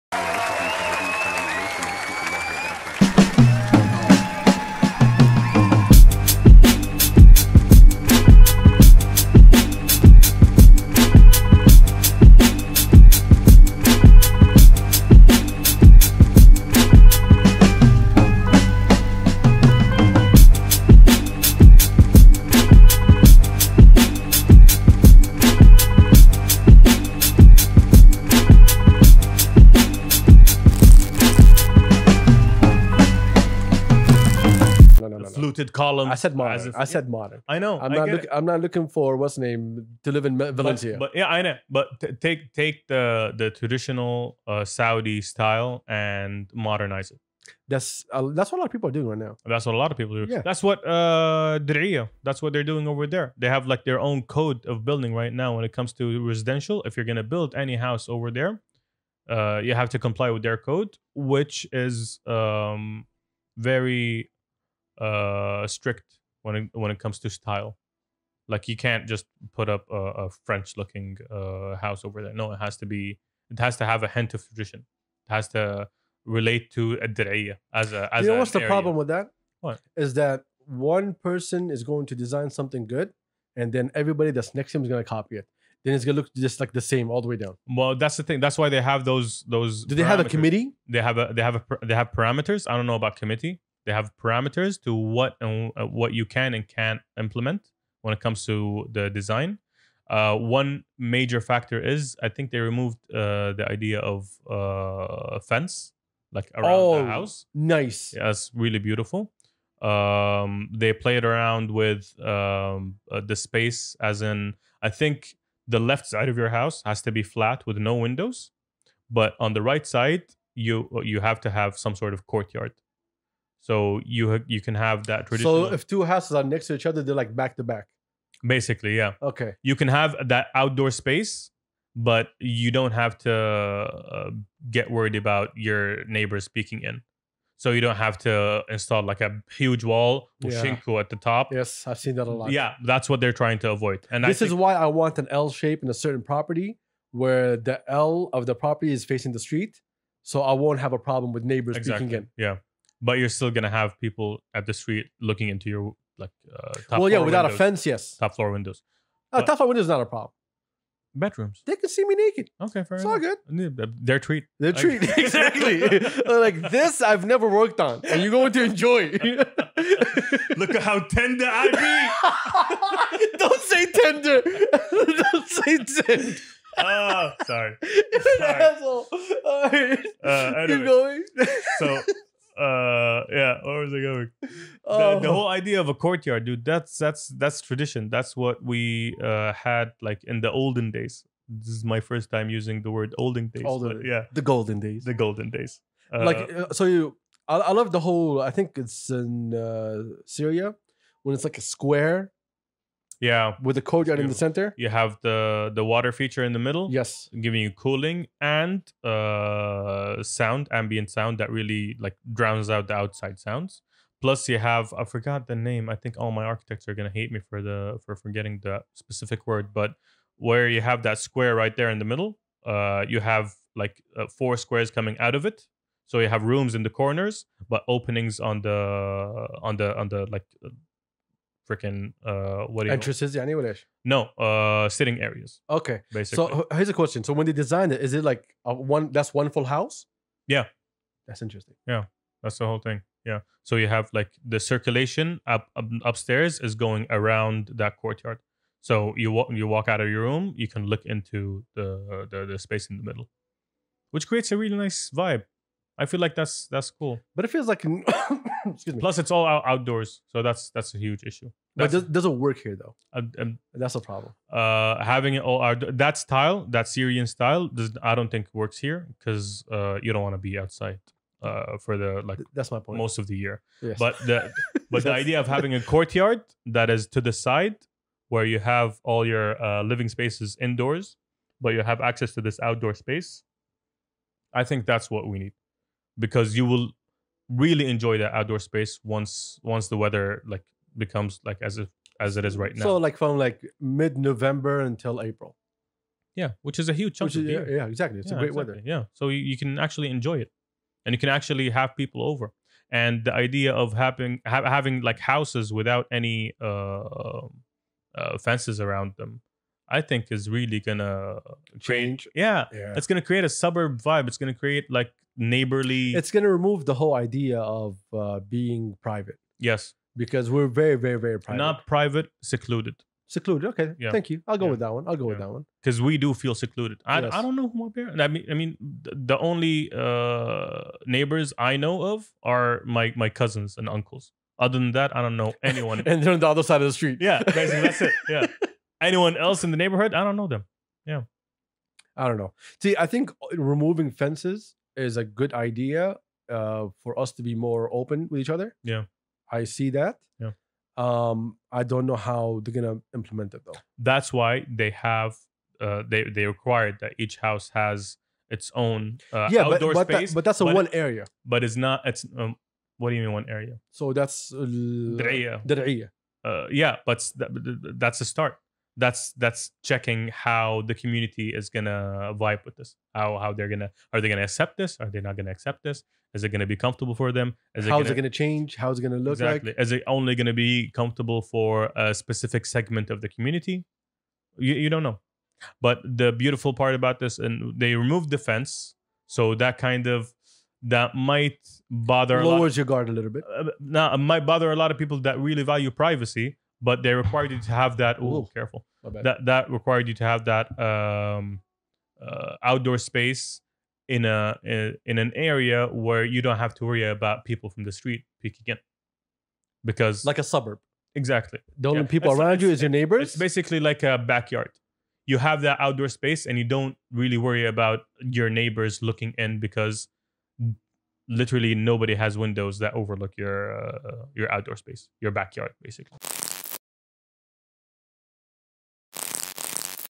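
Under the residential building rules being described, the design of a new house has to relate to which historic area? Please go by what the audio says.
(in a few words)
Diriyah.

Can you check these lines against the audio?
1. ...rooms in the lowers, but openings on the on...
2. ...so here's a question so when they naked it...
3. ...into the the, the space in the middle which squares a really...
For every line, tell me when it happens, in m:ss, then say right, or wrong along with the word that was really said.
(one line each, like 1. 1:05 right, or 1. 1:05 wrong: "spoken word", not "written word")
1. 3:46 wrong: "corners", not "lowers"
2. 3:56 wrong: "designed", not "naked"
3. 4:11 wrong: "creates", not "squares".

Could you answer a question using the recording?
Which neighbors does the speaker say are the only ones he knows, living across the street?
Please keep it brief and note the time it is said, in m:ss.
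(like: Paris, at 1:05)
Cousins and uncles, at 5:33.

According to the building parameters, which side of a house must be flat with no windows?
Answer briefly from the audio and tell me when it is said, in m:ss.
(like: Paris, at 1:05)
The left side, at 1:55.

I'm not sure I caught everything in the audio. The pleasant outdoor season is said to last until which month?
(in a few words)
April.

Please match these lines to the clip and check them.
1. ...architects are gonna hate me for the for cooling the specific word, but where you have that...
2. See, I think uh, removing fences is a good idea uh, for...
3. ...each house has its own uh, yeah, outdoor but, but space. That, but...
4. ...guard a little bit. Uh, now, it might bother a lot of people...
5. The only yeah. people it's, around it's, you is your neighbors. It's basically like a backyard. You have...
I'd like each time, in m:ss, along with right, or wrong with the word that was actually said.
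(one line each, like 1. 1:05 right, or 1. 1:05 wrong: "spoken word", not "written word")
1. 3:36 wrong: "forgetting", not "cooling"
2. 5:42 right
3. 5:57 right
4. 6:32 right
5. 6:51 right.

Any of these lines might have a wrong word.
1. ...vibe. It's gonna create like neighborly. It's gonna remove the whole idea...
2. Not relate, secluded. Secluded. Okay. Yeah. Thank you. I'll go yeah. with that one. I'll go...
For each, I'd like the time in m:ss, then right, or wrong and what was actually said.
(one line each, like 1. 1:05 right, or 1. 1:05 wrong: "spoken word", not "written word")
1. 5:14 right
2. 5:21 wrong: "private", not "relate".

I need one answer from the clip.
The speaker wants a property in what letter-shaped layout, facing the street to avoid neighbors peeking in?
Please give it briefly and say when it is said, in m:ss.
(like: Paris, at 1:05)
L shape, at 2:25.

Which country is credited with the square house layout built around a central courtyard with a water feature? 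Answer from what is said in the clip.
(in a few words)
Syria.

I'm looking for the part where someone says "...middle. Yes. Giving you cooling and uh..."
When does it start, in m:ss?
3:26.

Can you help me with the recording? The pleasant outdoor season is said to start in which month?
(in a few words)
November.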